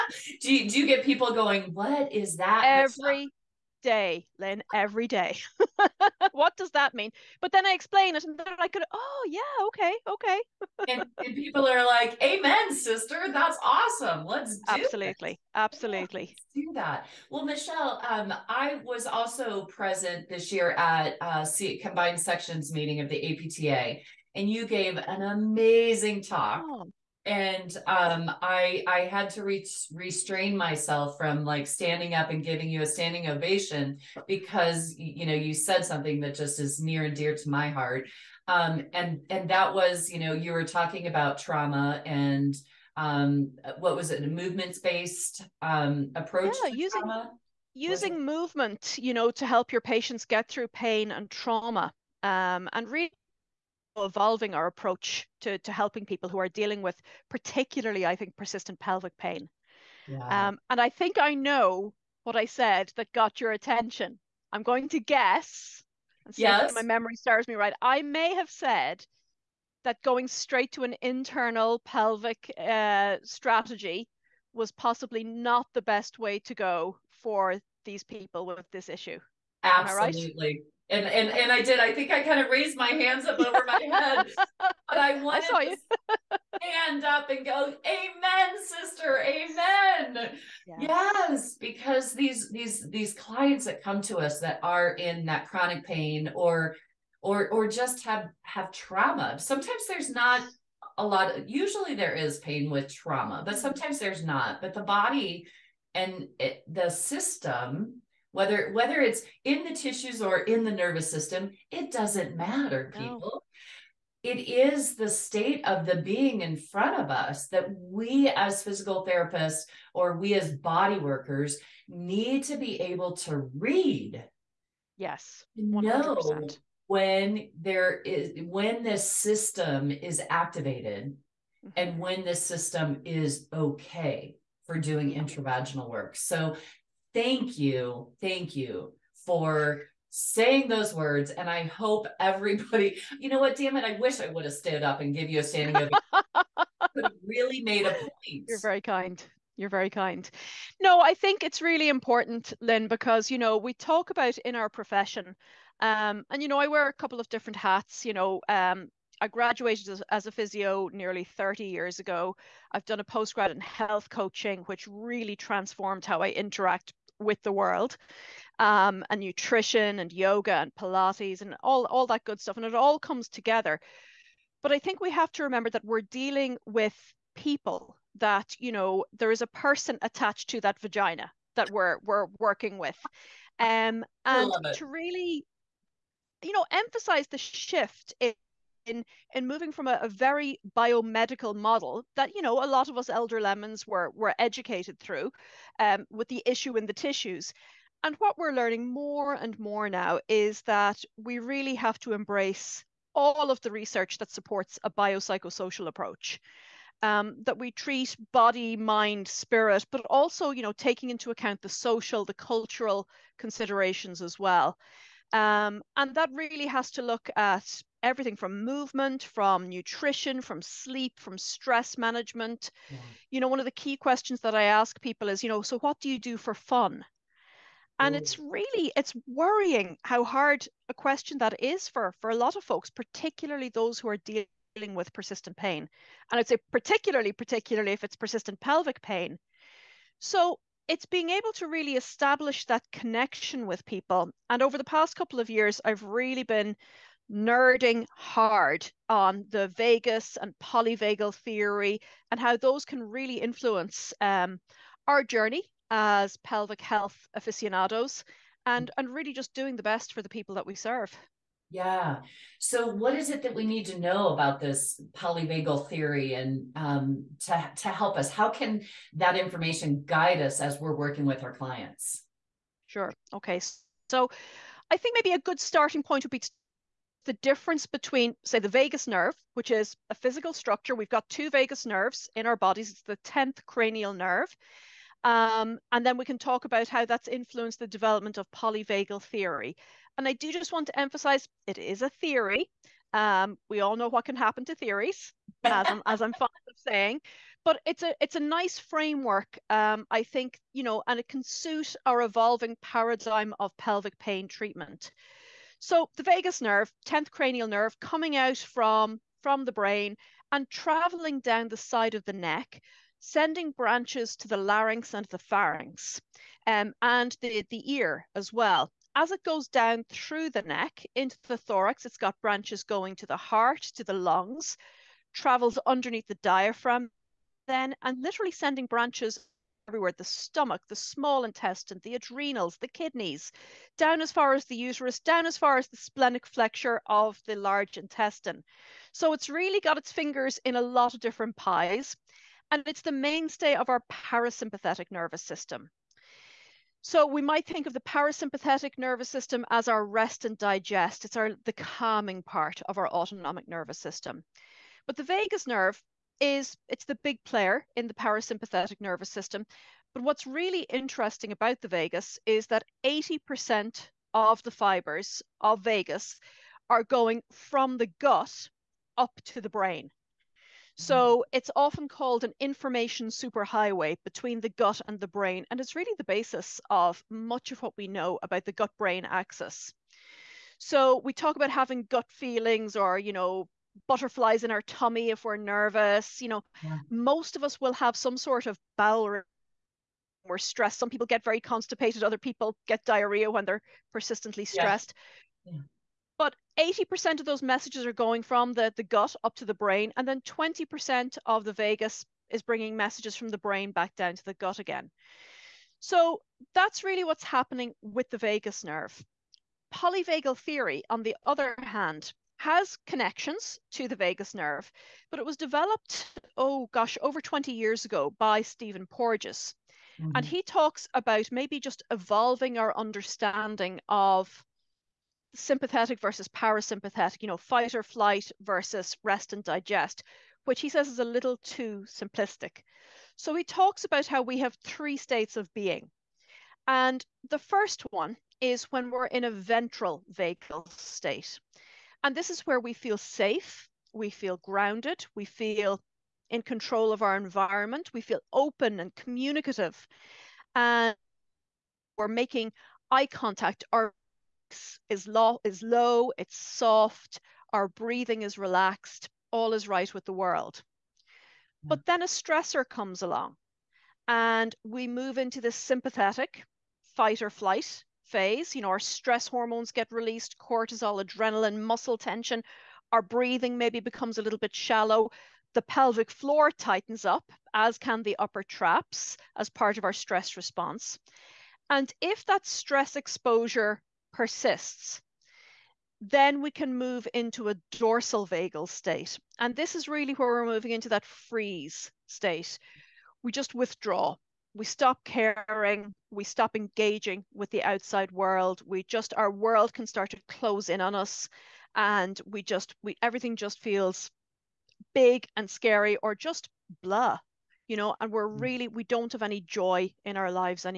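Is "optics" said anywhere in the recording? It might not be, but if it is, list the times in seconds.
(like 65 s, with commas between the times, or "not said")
not said.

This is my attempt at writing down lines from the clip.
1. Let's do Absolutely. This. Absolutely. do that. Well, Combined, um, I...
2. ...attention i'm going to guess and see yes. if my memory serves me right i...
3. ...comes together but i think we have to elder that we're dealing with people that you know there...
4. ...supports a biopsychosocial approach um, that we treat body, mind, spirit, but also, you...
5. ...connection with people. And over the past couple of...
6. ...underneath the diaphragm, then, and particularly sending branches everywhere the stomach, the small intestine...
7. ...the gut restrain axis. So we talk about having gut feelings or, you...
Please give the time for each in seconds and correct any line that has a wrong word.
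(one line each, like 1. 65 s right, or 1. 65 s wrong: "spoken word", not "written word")
1. 14 s wrong: "Michelle", not "Combined"
2. 63 s right
3. 172 s wrong: "remember", not "elder"
4. 204 s right
5. 242 s right
6. 325 s wrong: "literally", not "particularly"
7. 378 s wrong: "brain", not "restrain".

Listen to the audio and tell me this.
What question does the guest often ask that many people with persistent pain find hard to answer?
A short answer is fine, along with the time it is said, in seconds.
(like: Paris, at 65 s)
What do you do for fun?, at 225 s.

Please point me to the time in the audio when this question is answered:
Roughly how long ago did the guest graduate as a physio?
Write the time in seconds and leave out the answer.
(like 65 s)
160 s.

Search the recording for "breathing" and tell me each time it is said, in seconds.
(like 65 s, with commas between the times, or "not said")
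457 s, 473 s.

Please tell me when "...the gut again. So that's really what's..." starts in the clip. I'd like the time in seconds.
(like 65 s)
404 s.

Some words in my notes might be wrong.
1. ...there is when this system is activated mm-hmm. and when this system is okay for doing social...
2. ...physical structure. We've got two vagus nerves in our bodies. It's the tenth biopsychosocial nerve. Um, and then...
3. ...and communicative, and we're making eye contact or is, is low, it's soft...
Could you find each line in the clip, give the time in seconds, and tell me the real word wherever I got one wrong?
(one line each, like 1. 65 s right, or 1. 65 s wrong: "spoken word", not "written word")
1. 127 s wrong: "intravaginal", not "social"
2. 280 s wrong: "cranial", not "biopsychosocial"
3. 448 s right.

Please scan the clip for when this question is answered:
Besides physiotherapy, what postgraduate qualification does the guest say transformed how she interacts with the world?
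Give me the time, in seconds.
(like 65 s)
163 s.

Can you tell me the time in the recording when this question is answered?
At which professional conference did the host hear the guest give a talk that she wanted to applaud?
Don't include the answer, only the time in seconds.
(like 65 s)
21 s.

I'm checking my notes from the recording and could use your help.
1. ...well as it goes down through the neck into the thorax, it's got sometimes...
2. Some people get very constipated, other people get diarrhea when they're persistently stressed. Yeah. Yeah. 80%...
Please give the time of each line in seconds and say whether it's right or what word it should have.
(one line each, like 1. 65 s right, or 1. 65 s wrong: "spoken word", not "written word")
1. 318 s wrong: "branches", not "sometimes"
2. 390 s right.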